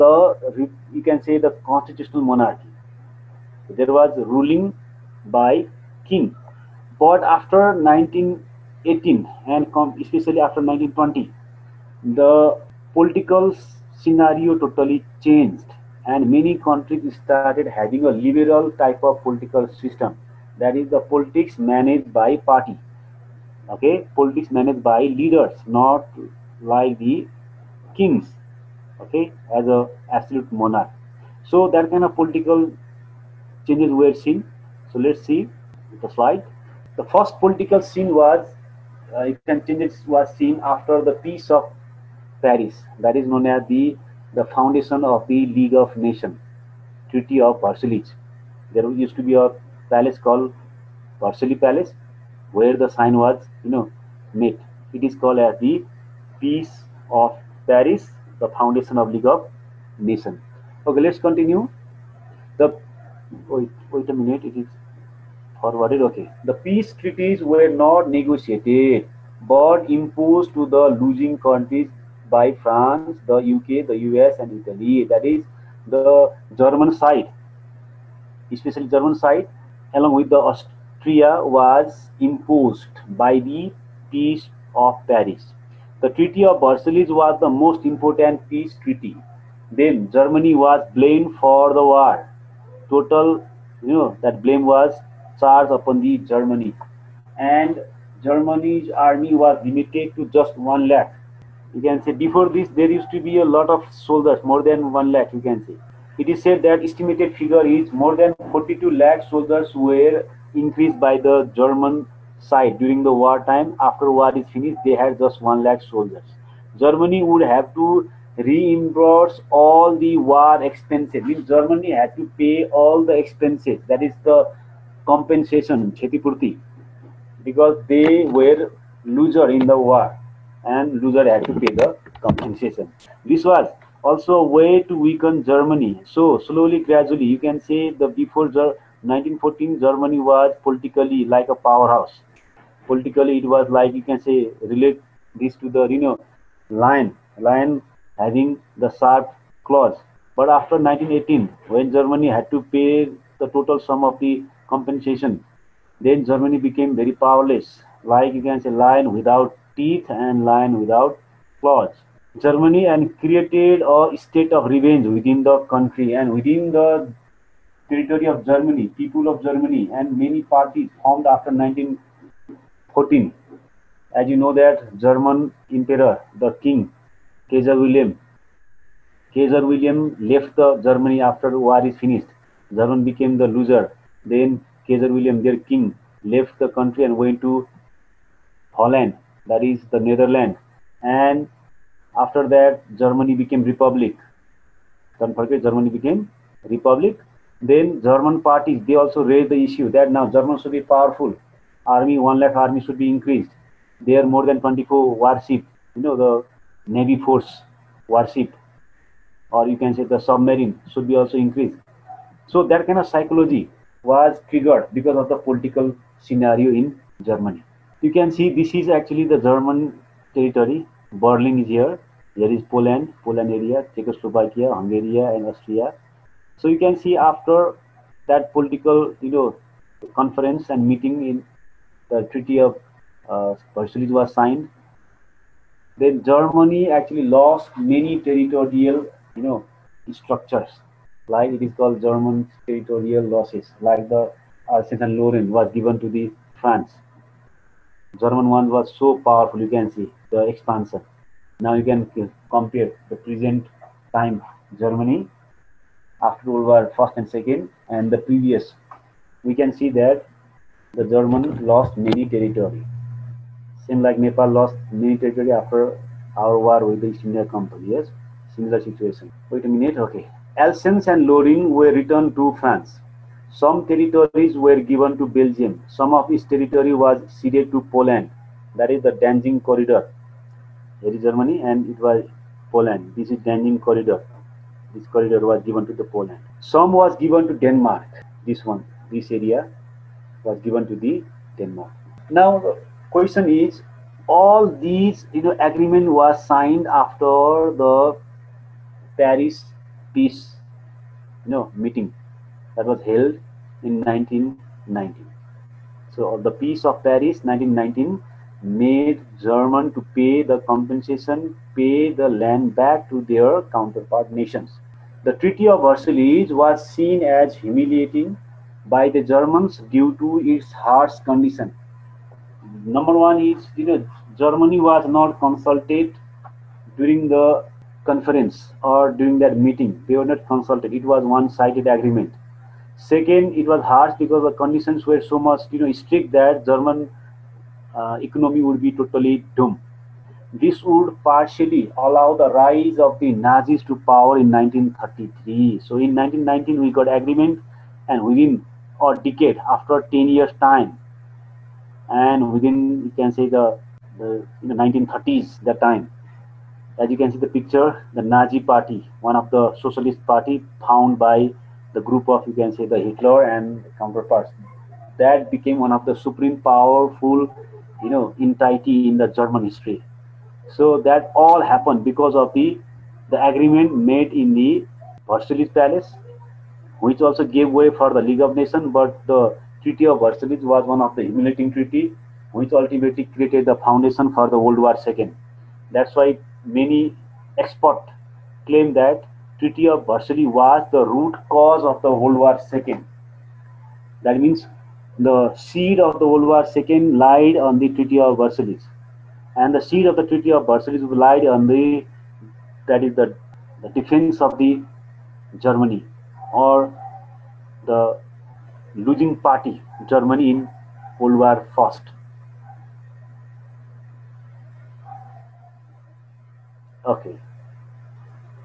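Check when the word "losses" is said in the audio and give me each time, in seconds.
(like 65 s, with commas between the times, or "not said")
243 s.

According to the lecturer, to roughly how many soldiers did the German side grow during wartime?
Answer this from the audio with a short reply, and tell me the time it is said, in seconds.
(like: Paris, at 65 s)
4.2 million (42 lakh), at 108 s.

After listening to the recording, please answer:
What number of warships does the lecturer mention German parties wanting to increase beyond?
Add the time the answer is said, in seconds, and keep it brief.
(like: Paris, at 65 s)
24, at 204 s.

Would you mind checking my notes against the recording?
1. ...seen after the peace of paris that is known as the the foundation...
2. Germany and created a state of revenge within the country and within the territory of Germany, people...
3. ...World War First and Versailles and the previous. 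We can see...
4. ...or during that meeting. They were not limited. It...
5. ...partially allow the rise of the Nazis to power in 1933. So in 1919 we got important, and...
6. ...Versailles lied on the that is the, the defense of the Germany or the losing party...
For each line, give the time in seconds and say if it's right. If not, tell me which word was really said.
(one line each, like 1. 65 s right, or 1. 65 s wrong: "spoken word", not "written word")
1. 40 s right
2. 162 s right
3. 256 s wrong: "Second", not "Versailles"
4. 328 s wrong: "consulted", not "limited"
5. 341 s wrong: "agreement", not "important"
6. 400 s right.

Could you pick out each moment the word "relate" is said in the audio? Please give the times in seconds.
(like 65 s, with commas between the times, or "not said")
144 s.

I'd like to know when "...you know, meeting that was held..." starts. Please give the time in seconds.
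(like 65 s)
301 s.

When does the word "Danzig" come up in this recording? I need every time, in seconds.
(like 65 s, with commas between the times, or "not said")
279 s, 283 s.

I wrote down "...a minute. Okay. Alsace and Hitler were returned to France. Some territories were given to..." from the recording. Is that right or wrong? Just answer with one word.
wrong.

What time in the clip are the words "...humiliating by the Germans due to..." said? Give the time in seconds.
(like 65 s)
317 s.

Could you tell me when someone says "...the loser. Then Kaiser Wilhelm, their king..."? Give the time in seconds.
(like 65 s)
183 s.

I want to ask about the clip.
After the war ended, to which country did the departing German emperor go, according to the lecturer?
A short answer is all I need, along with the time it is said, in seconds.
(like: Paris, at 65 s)
Holland, at 188 s.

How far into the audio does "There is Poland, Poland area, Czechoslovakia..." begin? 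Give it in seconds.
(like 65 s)
222 s.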